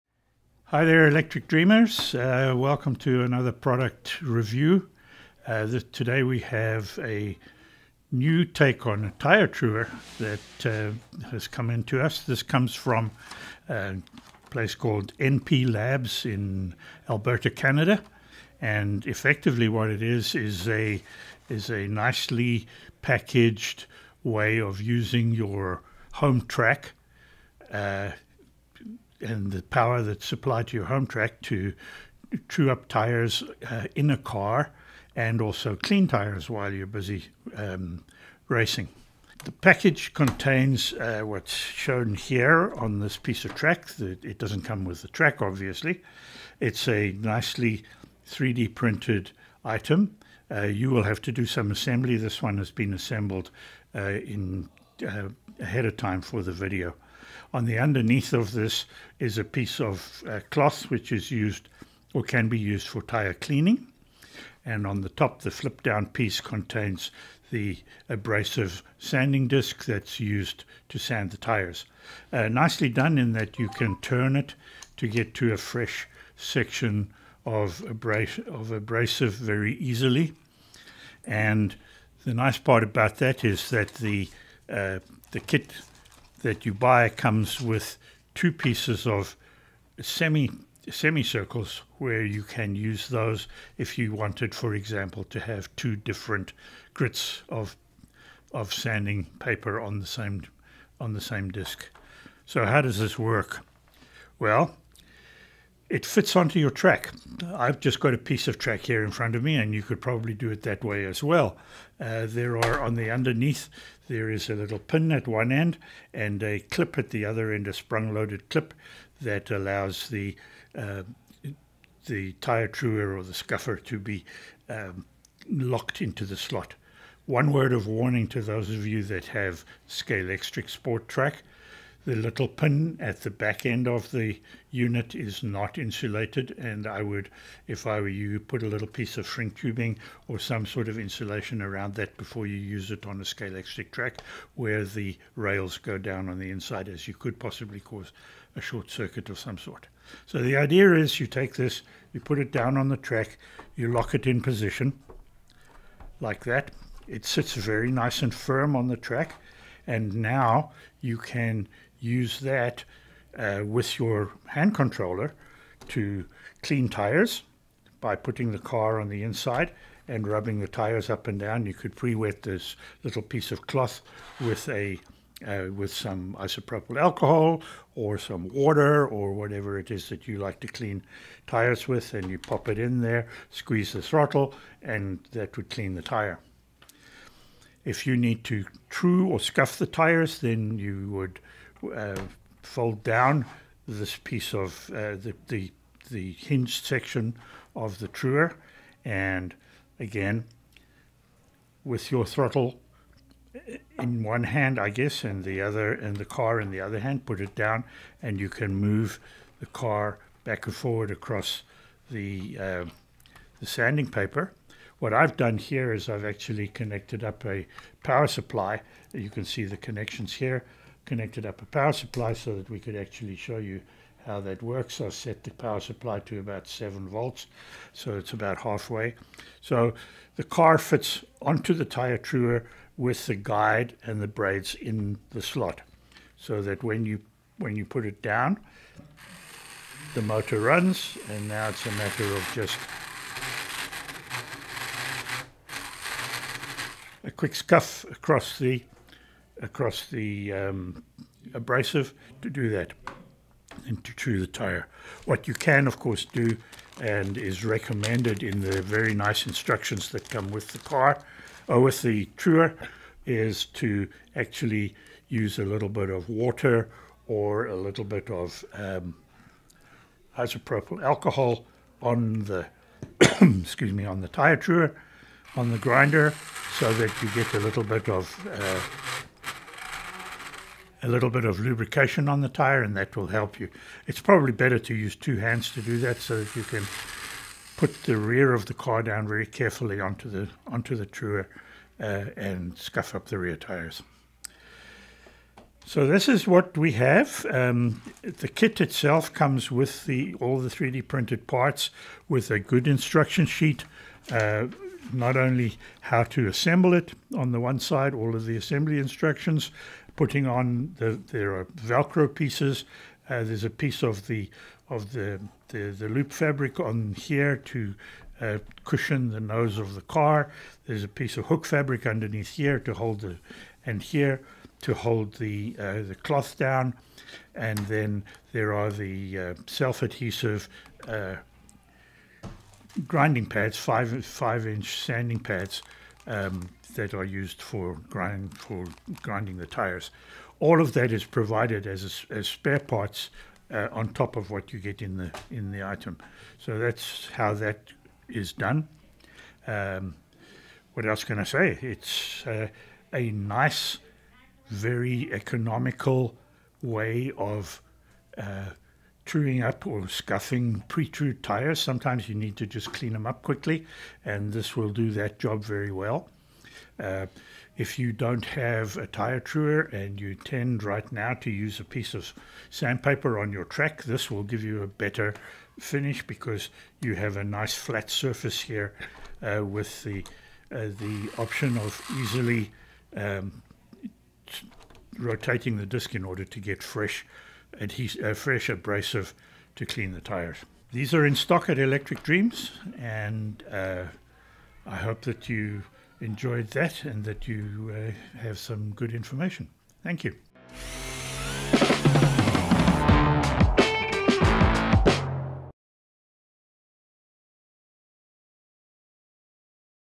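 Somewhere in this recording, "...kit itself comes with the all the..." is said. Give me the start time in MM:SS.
04:58.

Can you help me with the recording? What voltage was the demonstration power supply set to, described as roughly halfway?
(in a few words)
7 volts.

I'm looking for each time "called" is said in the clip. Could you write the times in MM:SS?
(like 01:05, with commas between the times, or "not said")
00:14.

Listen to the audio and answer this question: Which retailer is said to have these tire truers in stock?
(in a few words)
Electric Dreams.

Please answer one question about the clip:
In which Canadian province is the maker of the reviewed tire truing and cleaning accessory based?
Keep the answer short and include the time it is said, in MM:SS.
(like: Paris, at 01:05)
Alberta, at 00:17.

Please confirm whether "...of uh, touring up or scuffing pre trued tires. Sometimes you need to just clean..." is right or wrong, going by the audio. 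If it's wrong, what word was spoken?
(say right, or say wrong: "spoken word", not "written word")
right.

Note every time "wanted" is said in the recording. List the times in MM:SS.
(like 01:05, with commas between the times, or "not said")
01:34.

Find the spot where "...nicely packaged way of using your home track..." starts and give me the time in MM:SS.
00:21.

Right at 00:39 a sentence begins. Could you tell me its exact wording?
The package contains uh, what's shown here on this piece of track.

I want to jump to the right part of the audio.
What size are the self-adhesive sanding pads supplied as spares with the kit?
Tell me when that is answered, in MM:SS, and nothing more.
05:34.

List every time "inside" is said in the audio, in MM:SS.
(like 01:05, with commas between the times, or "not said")
02:26, 02:49.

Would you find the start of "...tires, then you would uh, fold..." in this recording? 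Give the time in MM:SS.
03:09.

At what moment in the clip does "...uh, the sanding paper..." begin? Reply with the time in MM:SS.
03:32.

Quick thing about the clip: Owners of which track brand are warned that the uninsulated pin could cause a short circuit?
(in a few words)
Scalextric Sport.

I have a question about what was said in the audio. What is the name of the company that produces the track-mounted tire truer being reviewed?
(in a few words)
NP Labs.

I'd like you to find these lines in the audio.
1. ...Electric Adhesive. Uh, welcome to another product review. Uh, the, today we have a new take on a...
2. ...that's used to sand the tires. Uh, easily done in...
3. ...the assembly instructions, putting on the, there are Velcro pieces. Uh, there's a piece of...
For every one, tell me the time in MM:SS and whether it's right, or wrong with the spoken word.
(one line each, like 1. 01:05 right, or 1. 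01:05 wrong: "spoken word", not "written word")
1. 00:01 wrong: "Dreamers", not "Adhesive"
2. 01:09 wrong: "nicely", not "easily"
3. 05:08 right.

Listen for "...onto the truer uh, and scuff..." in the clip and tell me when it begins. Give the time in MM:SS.
04:50.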